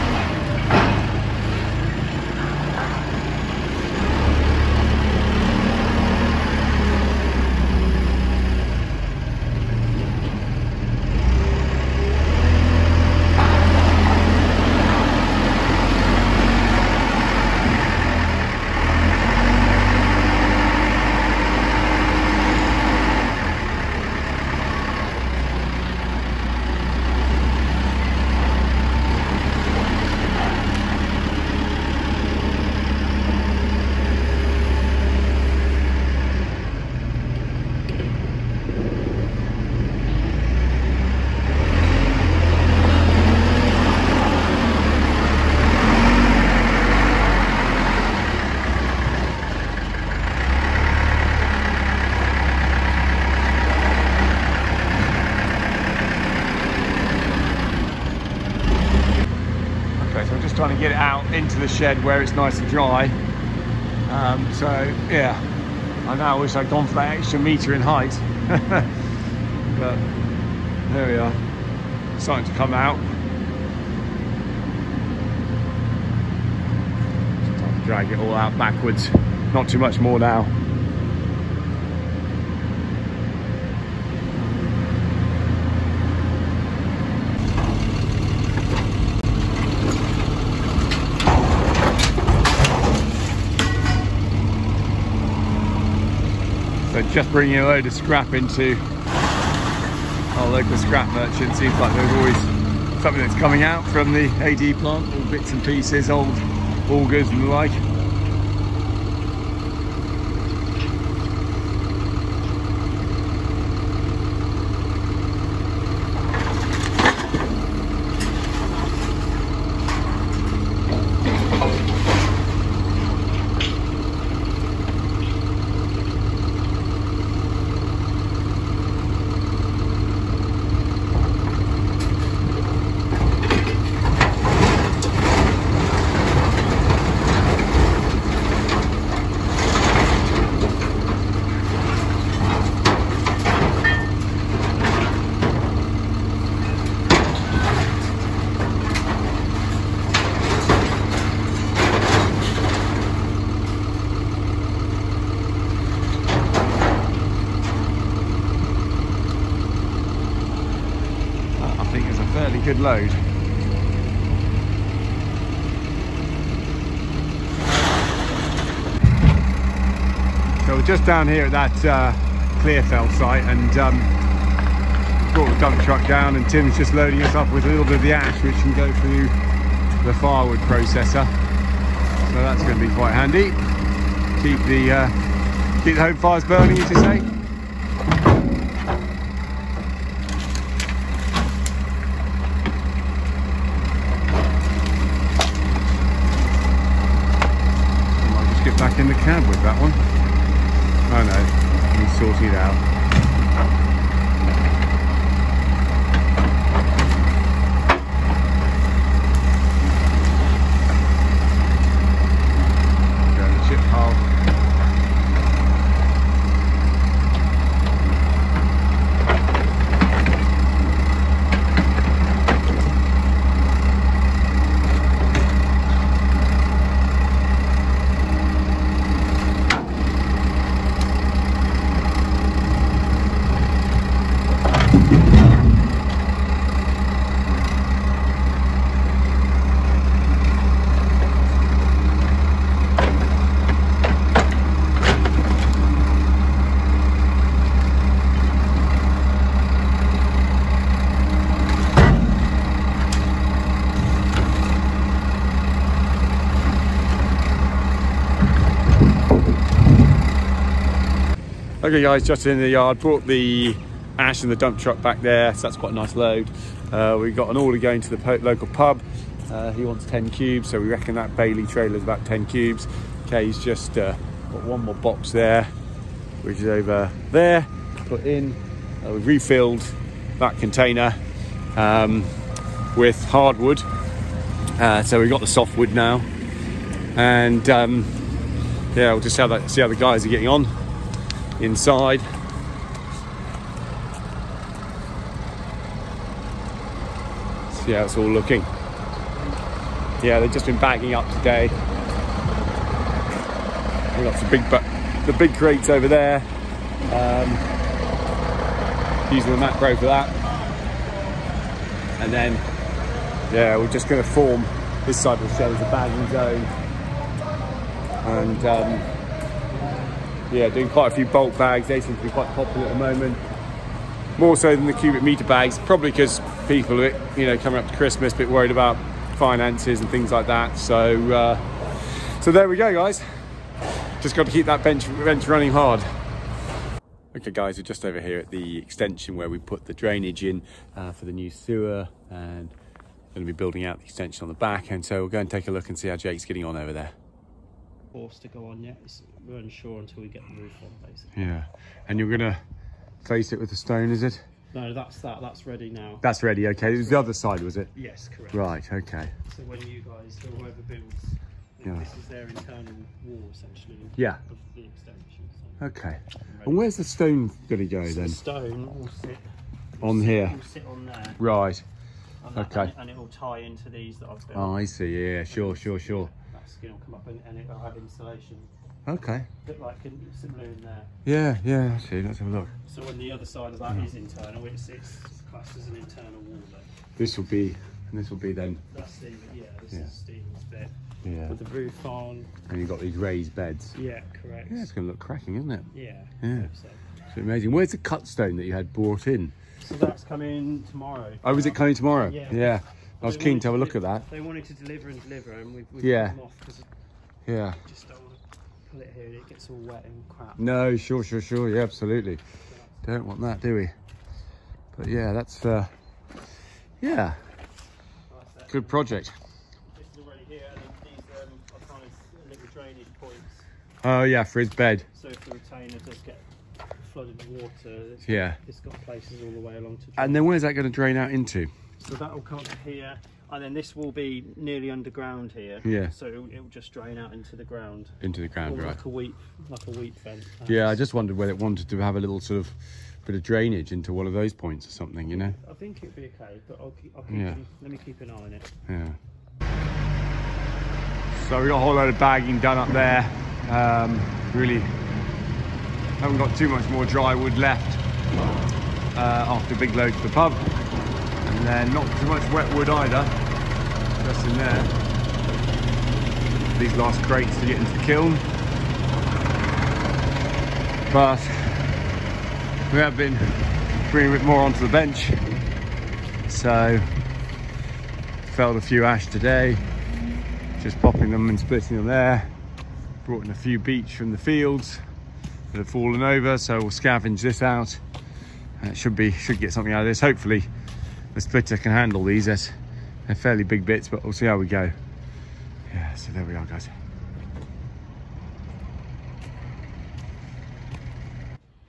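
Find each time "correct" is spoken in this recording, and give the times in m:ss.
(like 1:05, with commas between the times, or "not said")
5:58, 6:34.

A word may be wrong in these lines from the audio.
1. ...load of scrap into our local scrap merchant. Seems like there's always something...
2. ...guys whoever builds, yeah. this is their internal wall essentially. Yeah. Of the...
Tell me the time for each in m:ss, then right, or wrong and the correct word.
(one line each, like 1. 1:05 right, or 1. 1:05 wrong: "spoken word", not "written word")
1. 1:37 right
2. 6:00 right.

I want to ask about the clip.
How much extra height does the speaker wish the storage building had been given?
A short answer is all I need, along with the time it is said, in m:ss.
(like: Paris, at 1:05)
1 metre, at 1:07.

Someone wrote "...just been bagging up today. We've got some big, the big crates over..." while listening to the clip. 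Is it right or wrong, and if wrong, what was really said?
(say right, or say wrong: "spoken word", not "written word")
right.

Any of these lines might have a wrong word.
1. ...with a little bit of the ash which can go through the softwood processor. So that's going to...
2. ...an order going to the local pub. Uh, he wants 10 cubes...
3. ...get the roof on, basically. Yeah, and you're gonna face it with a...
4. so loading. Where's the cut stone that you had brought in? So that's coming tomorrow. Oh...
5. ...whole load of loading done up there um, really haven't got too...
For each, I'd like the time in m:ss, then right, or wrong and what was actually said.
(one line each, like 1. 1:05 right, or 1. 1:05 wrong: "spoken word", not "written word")
1. 2:57 wrong: "firewood", not "softwood"
2. 4:27 right
3. 5:50 right
4. 6:37 wrong: "amazing", not "loading"
5. 7:31 wrong: "bagging", not "loading".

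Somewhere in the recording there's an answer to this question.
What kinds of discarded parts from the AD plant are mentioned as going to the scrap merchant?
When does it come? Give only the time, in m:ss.
1:46.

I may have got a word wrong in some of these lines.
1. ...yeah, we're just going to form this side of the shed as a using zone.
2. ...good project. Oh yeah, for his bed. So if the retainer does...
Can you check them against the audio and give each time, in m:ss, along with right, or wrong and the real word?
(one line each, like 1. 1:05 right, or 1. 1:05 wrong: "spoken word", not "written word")
1. 5:13 wrong: "bagging", not "using"
2. 6:58 right.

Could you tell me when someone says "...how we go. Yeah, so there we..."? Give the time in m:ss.
8:14.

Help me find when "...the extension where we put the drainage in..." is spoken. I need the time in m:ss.
5:38.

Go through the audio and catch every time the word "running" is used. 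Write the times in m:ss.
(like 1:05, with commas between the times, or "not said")
5:35.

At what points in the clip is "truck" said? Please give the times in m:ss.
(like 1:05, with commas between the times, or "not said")
2:55, 4:24.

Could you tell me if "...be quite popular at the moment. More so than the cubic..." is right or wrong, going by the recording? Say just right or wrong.
right.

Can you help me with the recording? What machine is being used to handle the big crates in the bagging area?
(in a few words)
Matbro.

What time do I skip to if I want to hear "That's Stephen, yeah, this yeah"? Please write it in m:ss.
6:28.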